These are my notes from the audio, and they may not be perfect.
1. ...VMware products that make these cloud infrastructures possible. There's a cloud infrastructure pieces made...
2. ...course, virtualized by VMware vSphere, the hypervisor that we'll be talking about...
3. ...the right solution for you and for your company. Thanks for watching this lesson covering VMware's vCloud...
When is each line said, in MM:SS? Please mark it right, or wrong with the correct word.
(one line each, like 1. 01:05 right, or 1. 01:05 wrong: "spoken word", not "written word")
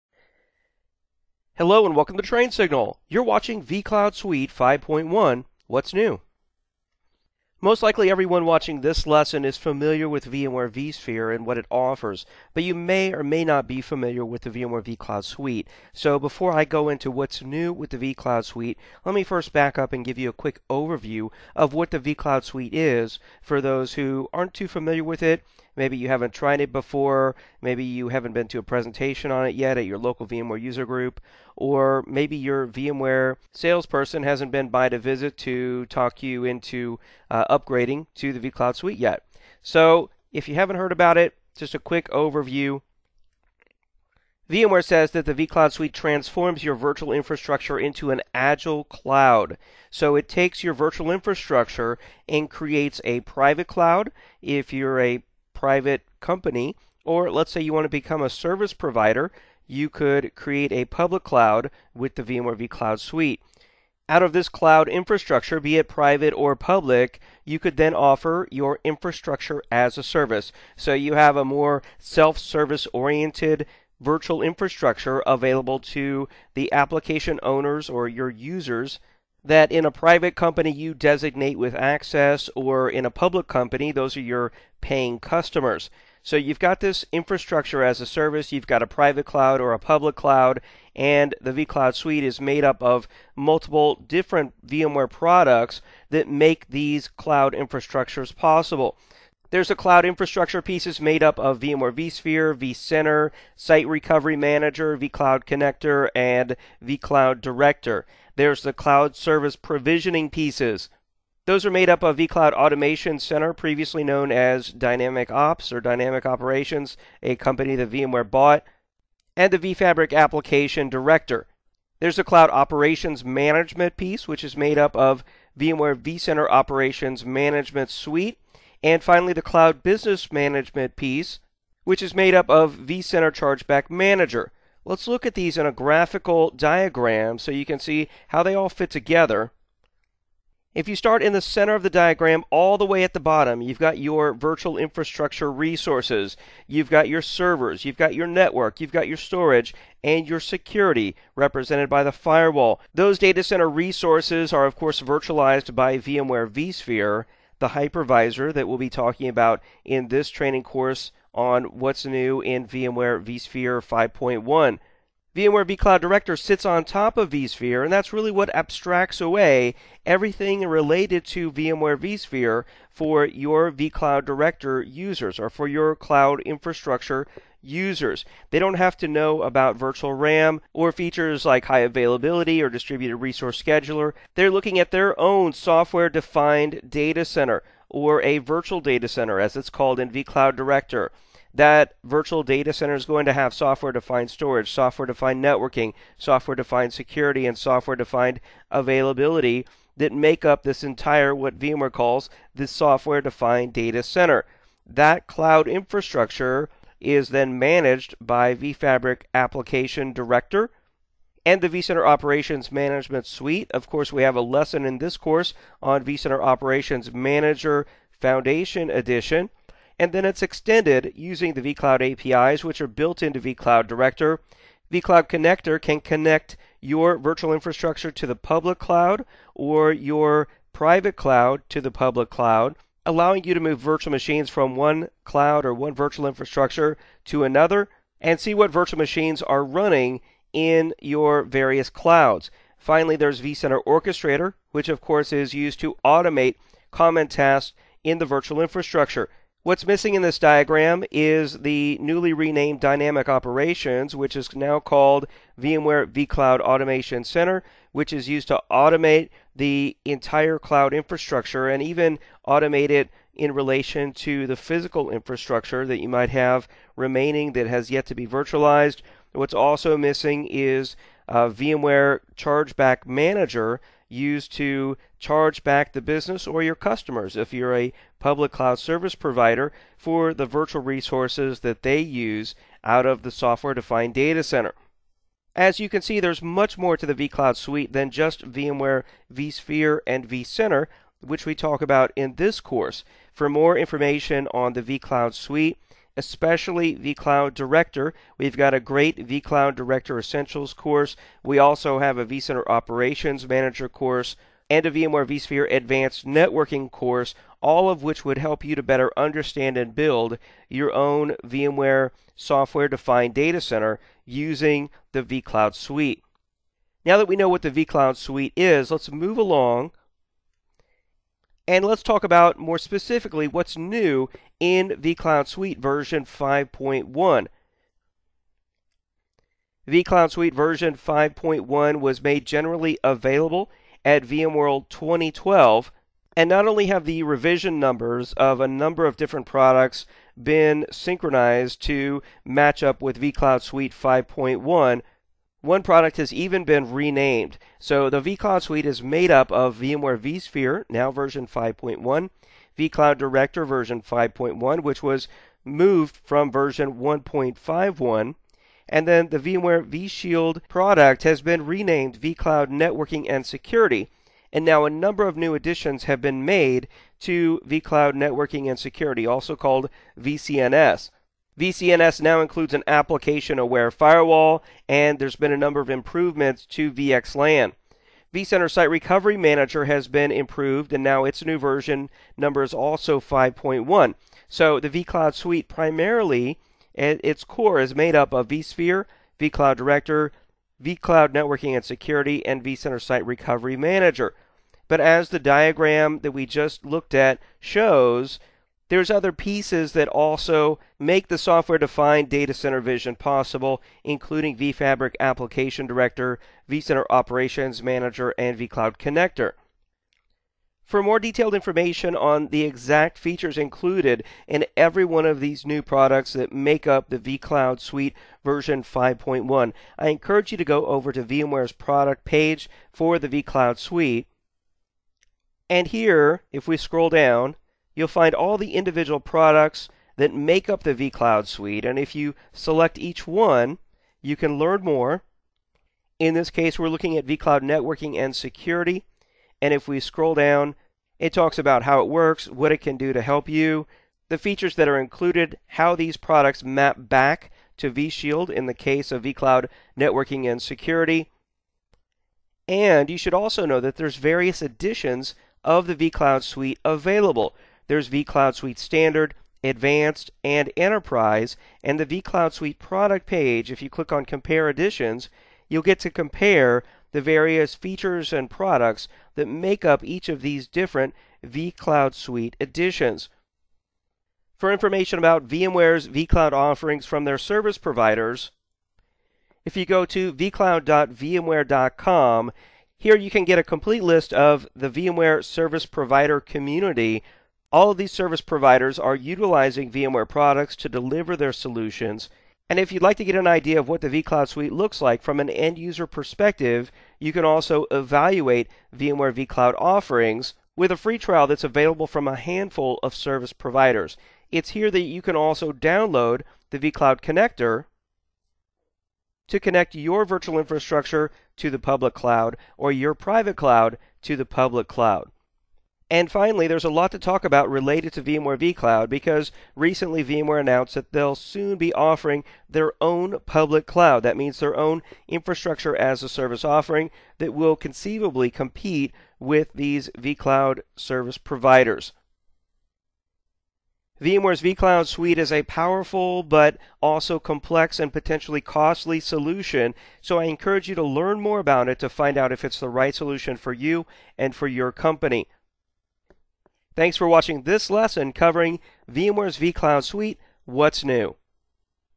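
1. 01:34 right
2. 02:34 right
3. 09:02 right.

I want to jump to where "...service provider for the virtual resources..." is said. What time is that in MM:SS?
04:38.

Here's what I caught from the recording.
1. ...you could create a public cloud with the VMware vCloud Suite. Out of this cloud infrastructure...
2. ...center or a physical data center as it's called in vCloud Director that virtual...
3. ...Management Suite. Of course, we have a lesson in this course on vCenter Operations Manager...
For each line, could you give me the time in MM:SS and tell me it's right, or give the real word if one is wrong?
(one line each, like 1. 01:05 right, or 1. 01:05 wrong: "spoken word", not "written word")
1. 00:59 right
2. 03:07 wrong: "virtual", not "physical"
3. 03:32 right.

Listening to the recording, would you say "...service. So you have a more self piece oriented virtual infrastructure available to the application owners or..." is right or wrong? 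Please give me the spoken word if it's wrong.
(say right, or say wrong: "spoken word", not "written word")
wrong: "service", not "piece".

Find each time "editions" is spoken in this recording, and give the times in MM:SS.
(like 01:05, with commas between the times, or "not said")
03:38, 07:34, 07:44, 07:52.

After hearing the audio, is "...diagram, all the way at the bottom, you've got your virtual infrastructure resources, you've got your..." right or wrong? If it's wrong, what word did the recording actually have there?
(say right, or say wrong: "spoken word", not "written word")
right.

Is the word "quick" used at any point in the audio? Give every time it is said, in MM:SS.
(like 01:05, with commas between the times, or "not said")
00:20, 00:41.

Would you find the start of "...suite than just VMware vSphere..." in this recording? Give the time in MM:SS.
04:47.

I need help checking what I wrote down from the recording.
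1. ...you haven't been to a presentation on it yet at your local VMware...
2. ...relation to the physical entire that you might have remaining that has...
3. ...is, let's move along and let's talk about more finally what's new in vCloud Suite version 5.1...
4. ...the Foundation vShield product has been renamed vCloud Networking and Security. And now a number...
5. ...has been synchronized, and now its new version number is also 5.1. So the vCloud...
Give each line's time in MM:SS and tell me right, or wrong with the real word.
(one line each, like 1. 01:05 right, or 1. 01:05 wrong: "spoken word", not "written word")
1. 00:27 right
2. 04:23 wrong: "infrastructure", not "entire"
3. 05:18 wrong: "specifically", not "finally"
4. 05:59 wrong: "VMware", not "Foundation"
5. 06:19 wrong: "improved", not "synchronized".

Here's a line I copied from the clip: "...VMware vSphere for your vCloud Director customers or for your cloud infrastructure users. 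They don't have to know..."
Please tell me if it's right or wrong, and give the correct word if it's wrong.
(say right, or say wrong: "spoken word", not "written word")
wrong: "users", not "customers".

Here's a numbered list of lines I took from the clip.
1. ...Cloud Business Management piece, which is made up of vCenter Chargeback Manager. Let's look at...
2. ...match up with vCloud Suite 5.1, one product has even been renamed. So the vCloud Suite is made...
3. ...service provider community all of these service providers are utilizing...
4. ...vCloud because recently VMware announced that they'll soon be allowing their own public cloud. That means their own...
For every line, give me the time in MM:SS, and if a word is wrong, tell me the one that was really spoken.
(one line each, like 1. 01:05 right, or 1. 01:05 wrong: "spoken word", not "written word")
1. 02:09 right
2. 05:42 right
3. 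08:05 right
4. 08:38 wrong: "offering", not "allowing".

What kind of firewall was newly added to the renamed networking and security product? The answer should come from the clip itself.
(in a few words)
application aware firewall.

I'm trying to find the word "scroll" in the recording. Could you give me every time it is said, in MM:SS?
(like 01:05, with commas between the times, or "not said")
07:06, 07:19.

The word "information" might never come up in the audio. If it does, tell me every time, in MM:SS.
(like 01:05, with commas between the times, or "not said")
04:53, 06:51, 07:54.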